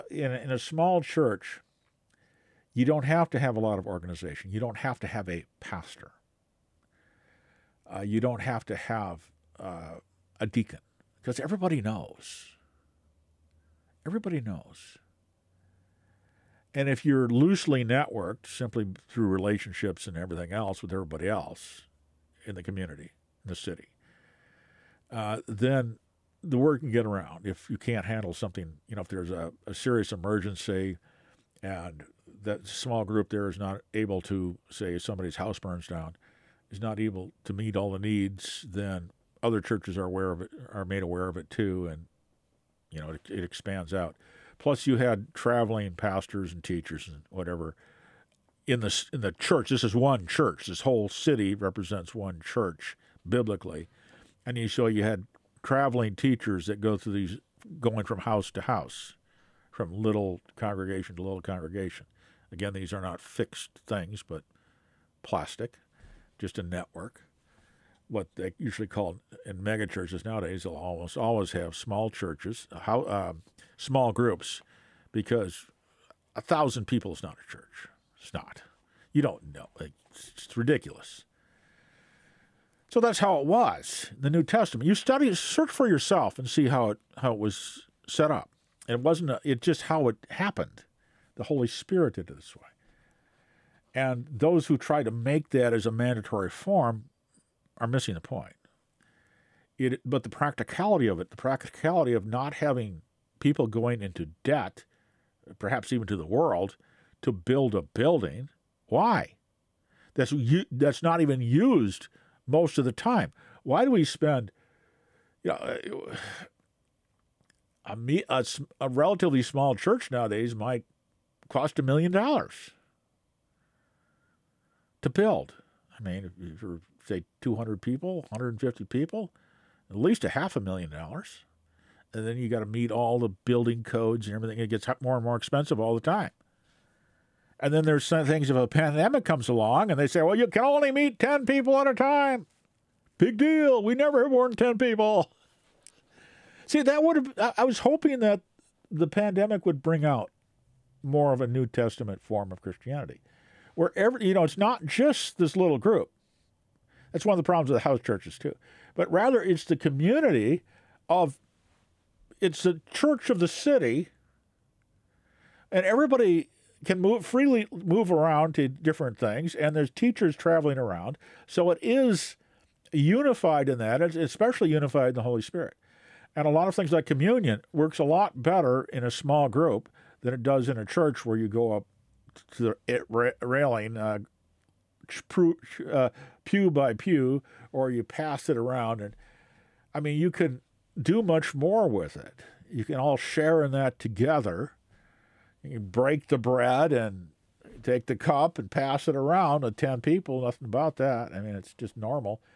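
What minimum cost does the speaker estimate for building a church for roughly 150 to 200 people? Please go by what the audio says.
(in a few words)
Half a million dollars.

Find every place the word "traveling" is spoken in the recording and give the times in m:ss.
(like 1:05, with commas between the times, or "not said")
0:45, 0:55, 2:50.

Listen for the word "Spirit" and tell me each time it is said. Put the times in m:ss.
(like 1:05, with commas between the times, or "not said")
1:31, 2:55.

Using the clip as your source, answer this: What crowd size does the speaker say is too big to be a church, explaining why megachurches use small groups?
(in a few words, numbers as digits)
1,000.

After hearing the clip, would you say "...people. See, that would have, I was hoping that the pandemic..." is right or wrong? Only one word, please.
right.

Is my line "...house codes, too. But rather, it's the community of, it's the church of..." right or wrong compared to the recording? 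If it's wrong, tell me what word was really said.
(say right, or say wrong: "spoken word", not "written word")
wrong: "churches", not "codes".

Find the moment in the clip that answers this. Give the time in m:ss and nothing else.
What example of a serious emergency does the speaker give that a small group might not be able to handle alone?
0:35.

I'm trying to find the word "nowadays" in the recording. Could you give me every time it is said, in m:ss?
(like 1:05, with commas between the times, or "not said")
1:10, 2:00.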